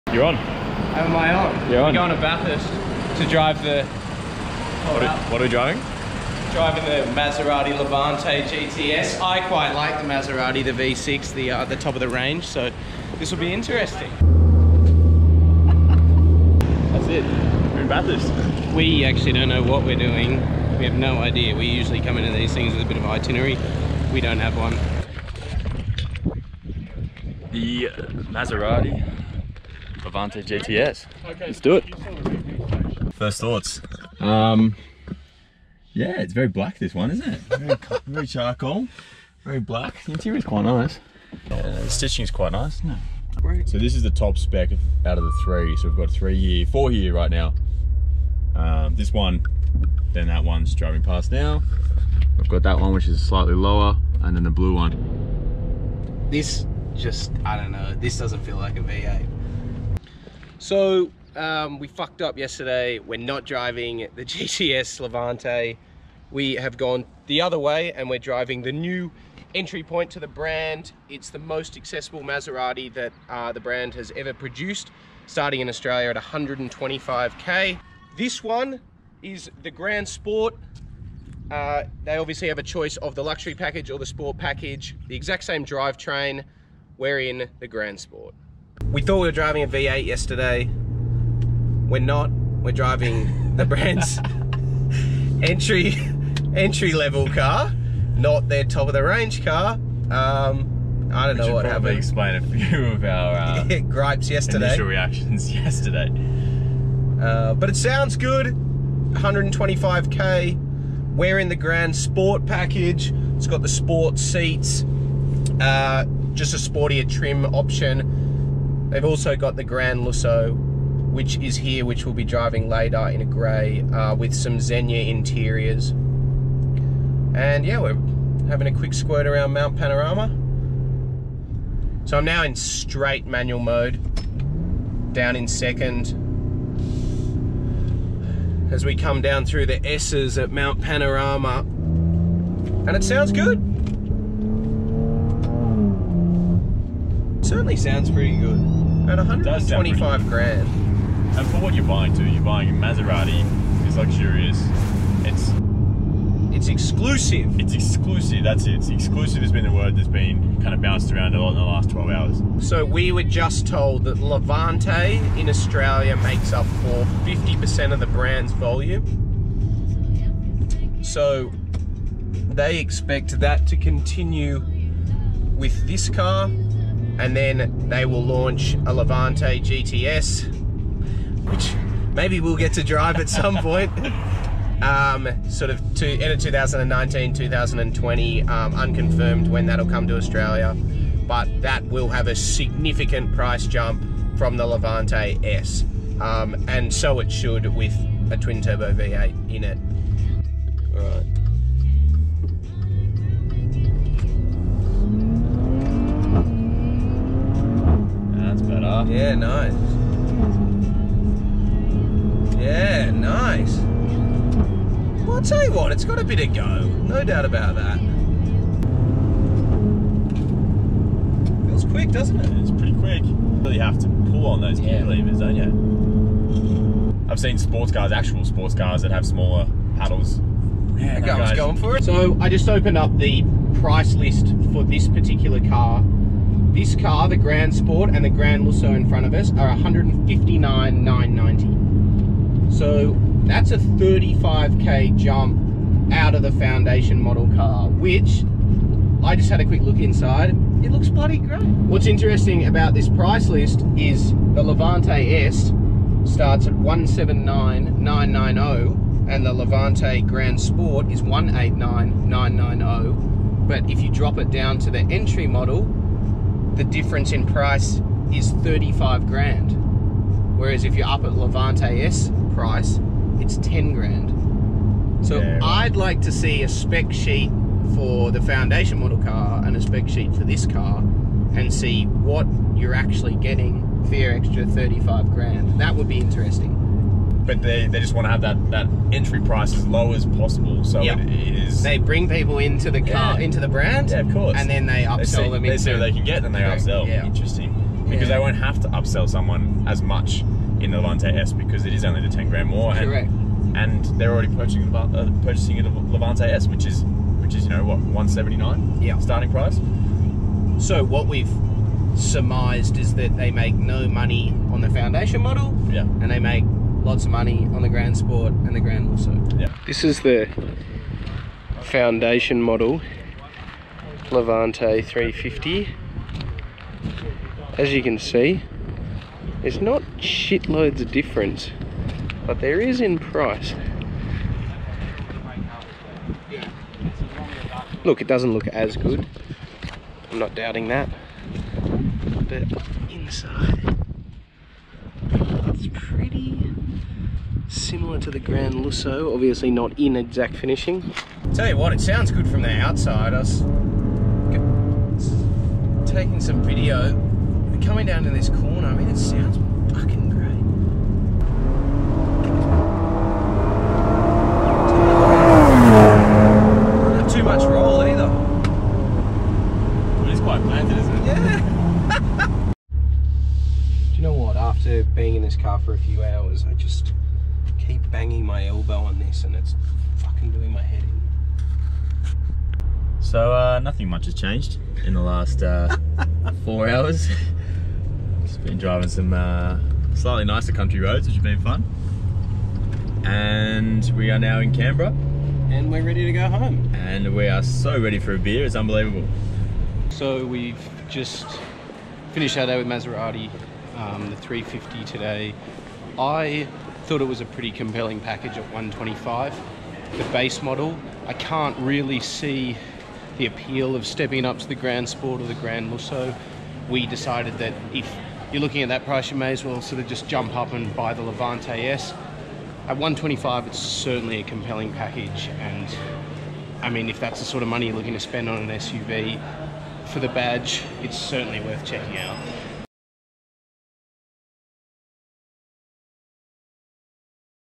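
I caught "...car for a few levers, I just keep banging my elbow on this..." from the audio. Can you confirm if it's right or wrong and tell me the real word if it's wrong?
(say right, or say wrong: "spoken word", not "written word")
wrong: "hours", not "levers".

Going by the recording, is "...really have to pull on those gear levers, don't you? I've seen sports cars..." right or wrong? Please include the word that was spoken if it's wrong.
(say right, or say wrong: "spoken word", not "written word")
right.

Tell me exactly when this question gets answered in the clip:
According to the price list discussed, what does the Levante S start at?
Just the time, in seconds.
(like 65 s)
256 s.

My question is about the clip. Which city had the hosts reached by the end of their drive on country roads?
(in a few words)
Canberra.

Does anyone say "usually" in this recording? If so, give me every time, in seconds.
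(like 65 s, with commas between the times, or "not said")
21 s.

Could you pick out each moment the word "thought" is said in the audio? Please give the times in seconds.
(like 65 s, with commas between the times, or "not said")
33 s, 89 s, 407 s.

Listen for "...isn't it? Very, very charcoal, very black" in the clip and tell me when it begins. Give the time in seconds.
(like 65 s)
37 s.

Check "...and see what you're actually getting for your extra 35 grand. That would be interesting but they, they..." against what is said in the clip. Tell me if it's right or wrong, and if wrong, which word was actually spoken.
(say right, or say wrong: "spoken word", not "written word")
right.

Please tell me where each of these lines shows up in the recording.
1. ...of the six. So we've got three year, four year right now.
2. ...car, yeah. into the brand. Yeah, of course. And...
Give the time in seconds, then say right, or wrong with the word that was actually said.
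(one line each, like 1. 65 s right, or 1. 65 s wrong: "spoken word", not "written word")
1. 45 s wrong: "three", not "six"
2. 293 s right.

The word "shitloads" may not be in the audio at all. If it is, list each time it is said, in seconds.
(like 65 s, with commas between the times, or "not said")
330 s.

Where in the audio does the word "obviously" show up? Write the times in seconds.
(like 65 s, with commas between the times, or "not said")
82 s, 349 s.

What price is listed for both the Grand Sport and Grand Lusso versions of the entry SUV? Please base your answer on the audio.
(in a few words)
159,990.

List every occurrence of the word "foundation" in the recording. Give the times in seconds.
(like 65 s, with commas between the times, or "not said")
246 s, 278 s, 314 s, 321 s.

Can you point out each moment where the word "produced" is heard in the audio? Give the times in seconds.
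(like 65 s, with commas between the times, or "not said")
74 s.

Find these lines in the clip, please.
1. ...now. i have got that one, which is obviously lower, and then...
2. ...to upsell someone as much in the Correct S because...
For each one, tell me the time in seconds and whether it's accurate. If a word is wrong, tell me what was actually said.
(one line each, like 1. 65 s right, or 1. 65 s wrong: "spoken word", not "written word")
1. 51 s wrong: "slightly", not "obviously"
2. 298 s wrong: "Levante", not "Correct".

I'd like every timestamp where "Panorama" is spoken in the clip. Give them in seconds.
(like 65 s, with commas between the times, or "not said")
129 s, 140 s.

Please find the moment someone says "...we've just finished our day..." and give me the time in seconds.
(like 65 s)
400 s.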